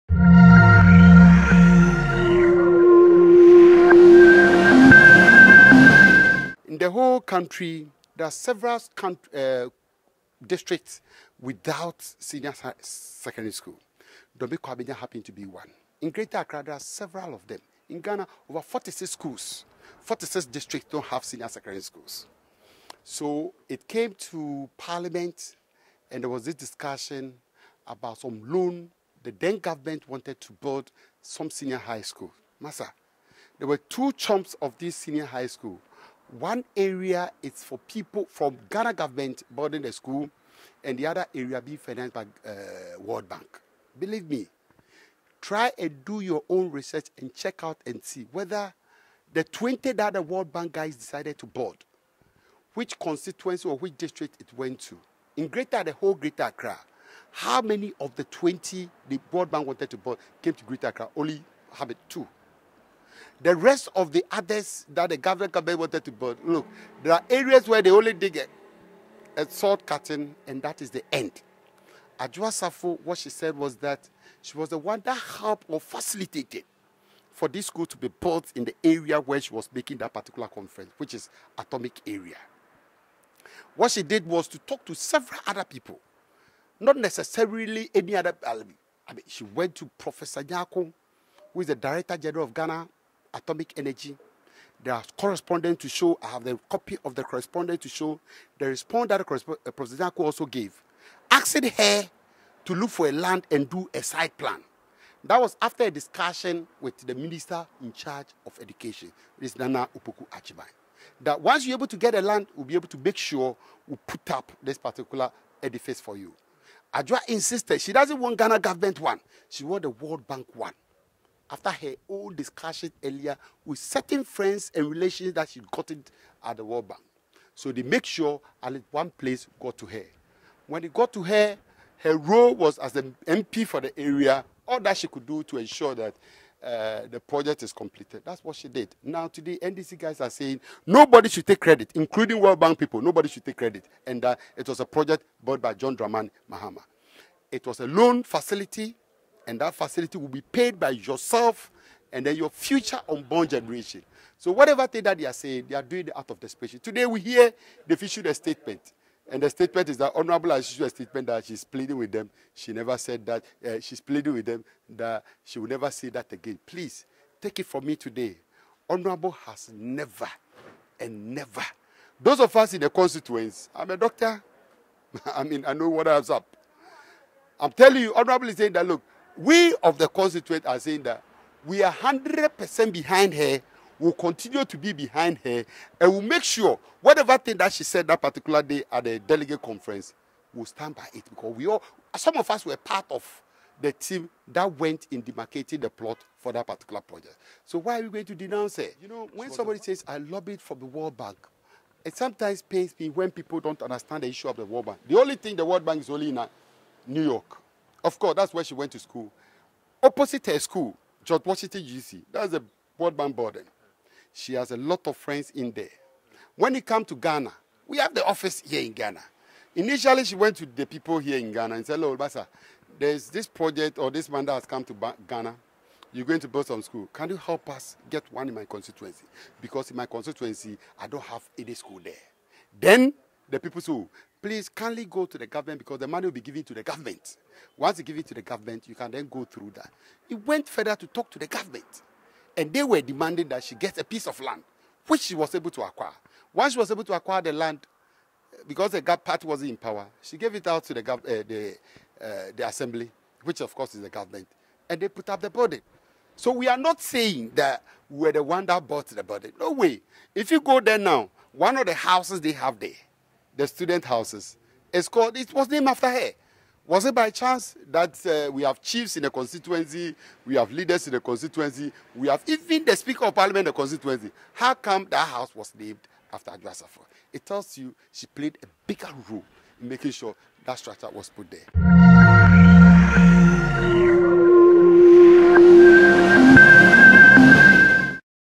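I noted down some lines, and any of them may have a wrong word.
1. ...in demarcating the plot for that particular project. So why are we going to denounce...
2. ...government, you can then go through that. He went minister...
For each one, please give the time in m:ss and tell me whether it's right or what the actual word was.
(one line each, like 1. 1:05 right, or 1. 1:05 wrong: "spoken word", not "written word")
1. 3:15 right
2. 3:58 wrong: "further", not "minister".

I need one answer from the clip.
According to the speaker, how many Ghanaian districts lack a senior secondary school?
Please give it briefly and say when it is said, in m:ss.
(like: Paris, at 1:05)
46, at 0:20.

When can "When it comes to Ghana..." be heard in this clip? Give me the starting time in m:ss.
3:36.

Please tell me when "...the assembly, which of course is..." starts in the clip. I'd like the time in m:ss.
4:12.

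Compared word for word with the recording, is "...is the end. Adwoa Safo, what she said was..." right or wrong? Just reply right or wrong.
right.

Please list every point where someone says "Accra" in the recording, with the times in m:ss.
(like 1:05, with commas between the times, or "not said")
0:16, 0:56, 1:00.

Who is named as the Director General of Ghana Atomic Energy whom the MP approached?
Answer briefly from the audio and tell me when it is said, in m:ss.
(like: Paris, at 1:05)
Professor Nyarko, at 1:29.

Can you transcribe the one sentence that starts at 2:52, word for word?
Those of us in the constituents, I'm a doctor.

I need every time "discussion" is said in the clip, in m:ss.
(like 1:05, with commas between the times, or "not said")
0:26, 1:45, 2:02.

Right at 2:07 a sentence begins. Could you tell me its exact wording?
So they make sure at least one place got to her.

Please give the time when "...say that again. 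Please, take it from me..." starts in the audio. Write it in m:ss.
2:45.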